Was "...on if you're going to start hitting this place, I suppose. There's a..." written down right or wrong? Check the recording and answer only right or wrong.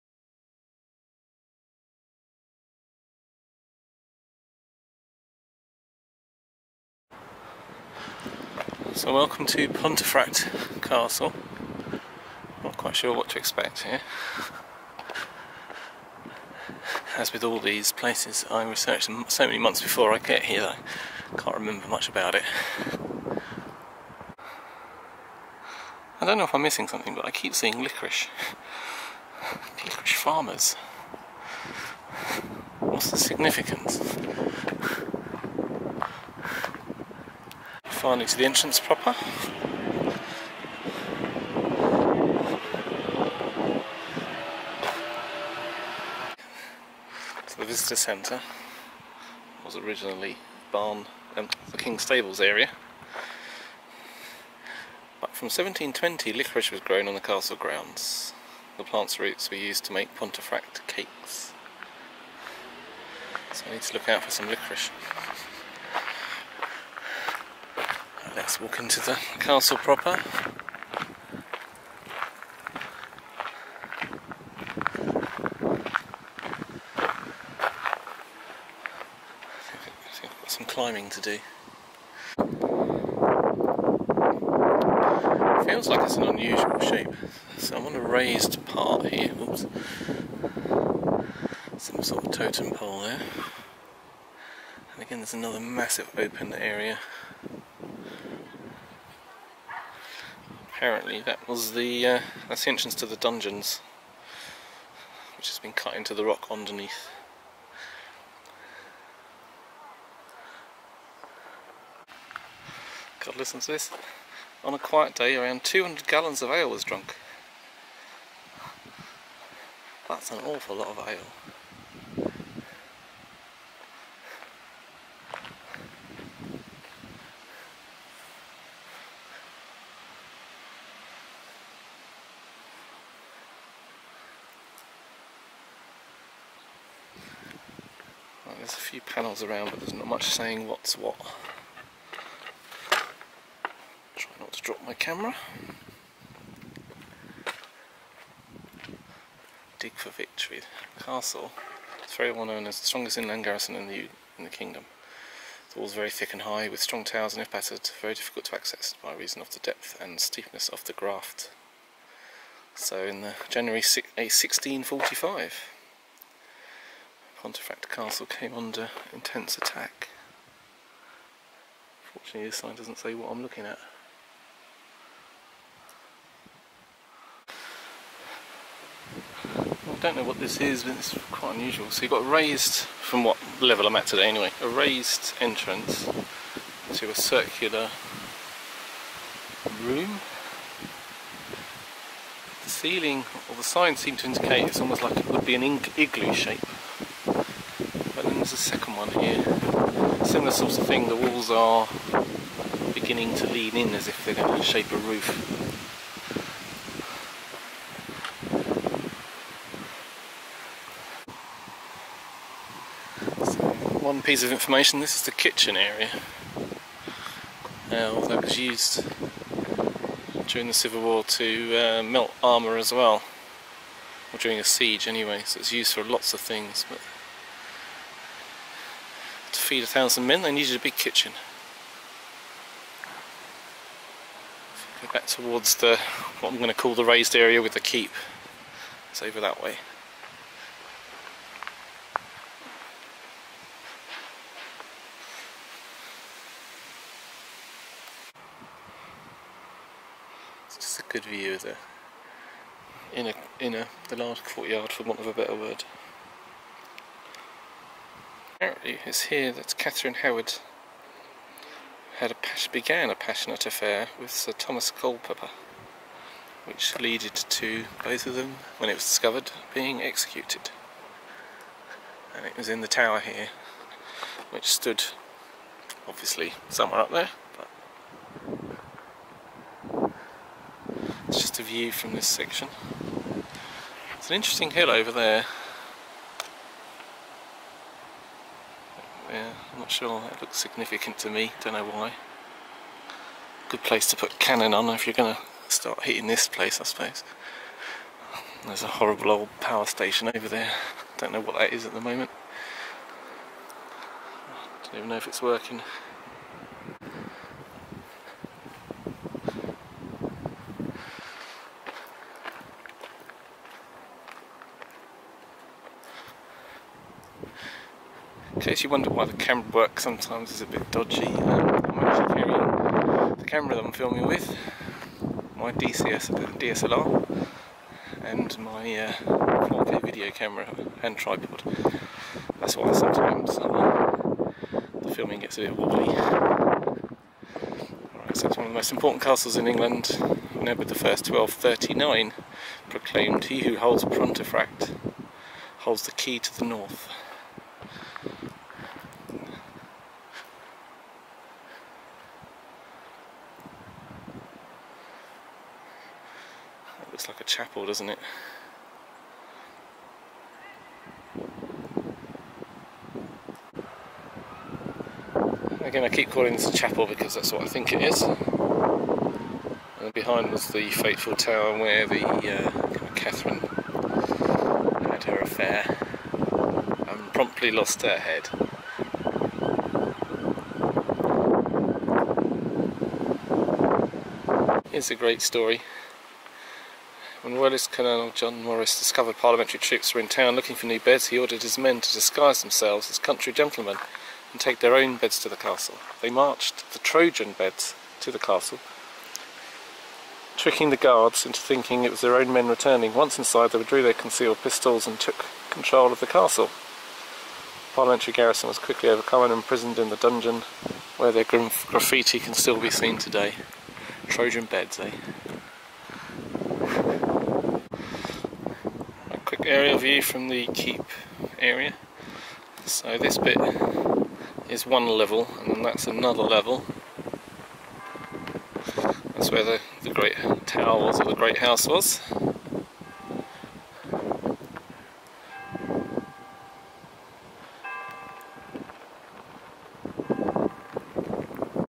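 right.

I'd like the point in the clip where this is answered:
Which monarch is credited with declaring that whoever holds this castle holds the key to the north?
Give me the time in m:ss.
5:40.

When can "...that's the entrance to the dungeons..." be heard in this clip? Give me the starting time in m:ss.
1:42.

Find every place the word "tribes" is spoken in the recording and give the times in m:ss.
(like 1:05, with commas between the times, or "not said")
not said.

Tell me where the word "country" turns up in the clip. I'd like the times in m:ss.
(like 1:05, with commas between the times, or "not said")
6:33.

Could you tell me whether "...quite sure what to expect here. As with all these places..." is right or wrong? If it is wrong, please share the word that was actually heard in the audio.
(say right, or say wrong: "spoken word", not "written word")
right.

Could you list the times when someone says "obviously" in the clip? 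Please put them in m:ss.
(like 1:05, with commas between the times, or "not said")
4:36.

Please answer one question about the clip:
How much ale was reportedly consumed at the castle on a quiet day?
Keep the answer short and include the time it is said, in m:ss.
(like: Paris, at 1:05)
200 gallons, at 1:55.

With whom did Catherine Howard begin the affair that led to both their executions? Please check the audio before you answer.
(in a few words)
Sir Thomas Culpepper.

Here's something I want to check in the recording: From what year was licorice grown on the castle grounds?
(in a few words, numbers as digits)
1720.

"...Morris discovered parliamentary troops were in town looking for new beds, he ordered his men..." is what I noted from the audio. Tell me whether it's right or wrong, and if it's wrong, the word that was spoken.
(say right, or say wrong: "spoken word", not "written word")
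right.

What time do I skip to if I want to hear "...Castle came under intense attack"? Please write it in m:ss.
2:47.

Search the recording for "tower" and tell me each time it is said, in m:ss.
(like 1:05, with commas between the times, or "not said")
2:37, 4:32, 6:11, 7:10.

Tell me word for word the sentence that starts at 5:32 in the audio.
That's why sometimes uh, the filming gets a bit wobbly.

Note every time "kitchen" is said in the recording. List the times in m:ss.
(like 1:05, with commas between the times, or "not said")
3:35, 3:50.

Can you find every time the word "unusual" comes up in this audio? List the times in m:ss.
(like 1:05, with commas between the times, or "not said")
1:26, 3:01.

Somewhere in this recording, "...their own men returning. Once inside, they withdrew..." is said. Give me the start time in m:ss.
6:42.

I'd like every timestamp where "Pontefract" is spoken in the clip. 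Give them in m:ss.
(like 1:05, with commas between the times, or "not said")
0:09, 1:00, 2:47, 5:44.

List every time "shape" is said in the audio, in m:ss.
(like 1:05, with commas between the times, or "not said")
1:26, 3:16, 3:24.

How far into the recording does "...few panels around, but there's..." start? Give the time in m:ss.
2:18.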